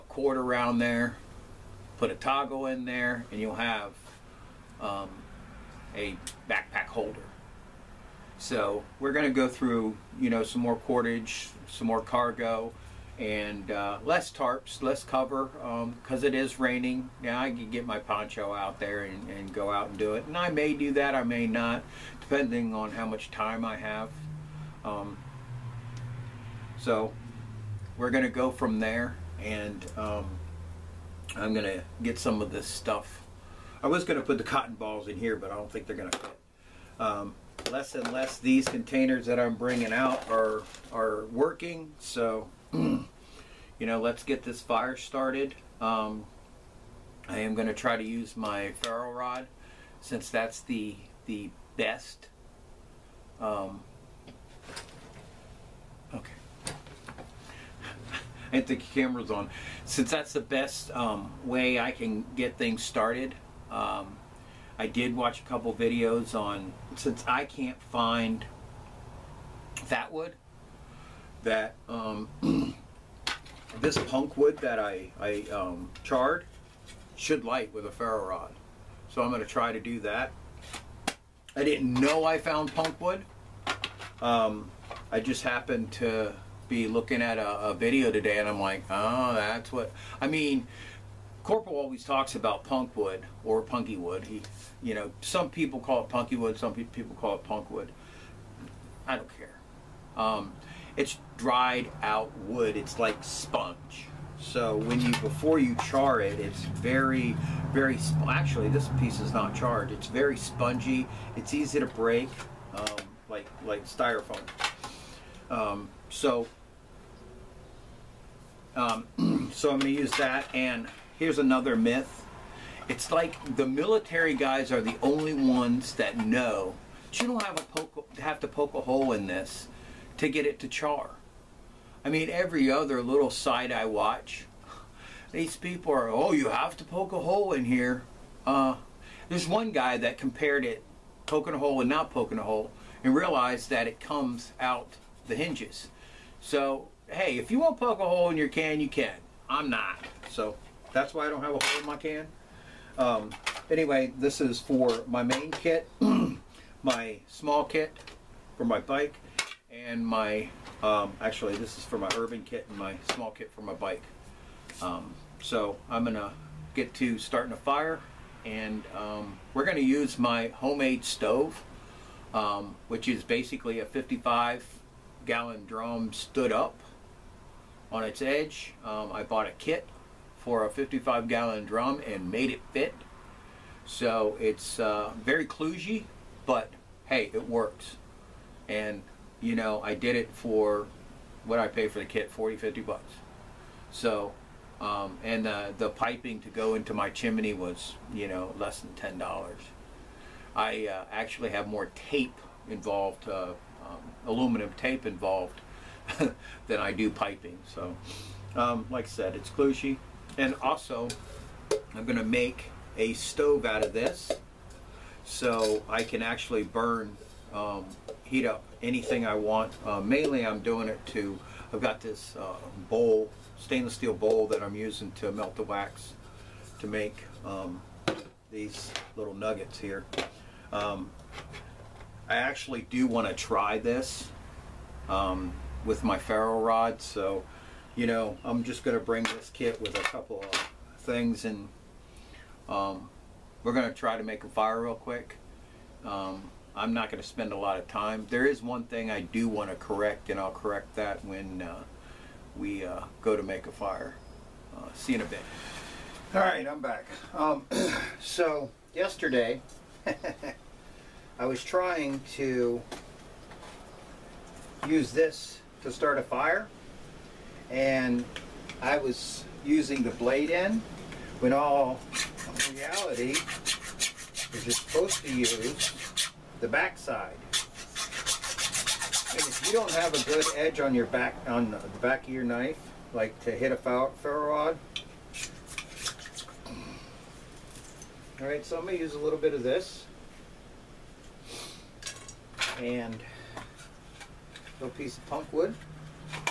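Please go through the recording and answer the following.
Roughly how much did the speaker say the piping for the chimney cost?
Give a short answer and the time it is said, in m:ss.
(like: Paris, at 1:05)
less than $10, at 3:18.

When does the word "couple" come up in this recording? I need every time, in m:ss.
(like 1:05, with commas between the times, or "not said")
1:05, 4:00.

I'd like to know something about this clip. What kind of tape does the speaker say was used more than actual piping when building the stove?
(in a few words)
aluminum tape.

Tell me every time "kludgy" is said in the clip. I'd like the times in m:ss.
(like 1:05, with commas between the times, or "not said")
3:05.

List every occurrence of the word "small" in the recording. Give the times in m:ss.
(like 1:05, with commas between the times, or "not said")
2:37, 2:43.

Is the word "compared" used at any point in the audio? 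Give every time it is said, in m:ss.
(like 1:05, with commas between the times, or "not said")
2:20.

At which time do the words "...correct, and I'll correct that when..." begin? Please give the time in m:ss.
4:09.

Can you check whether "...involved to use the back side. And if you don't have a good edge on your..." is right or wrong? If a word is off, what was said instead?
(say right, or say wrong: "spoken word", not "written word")
wrong: "supposed", not "involved".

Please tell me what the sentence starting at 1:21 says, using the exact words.
I didn't know I found punk wood.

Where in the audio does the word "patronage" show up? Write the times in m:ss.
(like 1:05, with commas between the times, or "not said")
not said.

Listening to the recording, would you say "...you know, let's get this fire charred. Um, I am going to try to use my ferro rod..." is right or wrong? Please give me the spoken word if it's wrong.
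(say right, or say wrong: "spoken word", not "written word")
wrong: "started", not "charred".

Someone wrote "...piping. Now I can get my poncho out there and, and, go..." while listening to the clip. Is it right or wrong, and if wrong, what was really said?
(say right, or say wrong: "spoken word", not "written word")
wrong: "raining", not "piping".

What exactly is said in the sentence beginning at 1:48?
Actually, this piece is not charred.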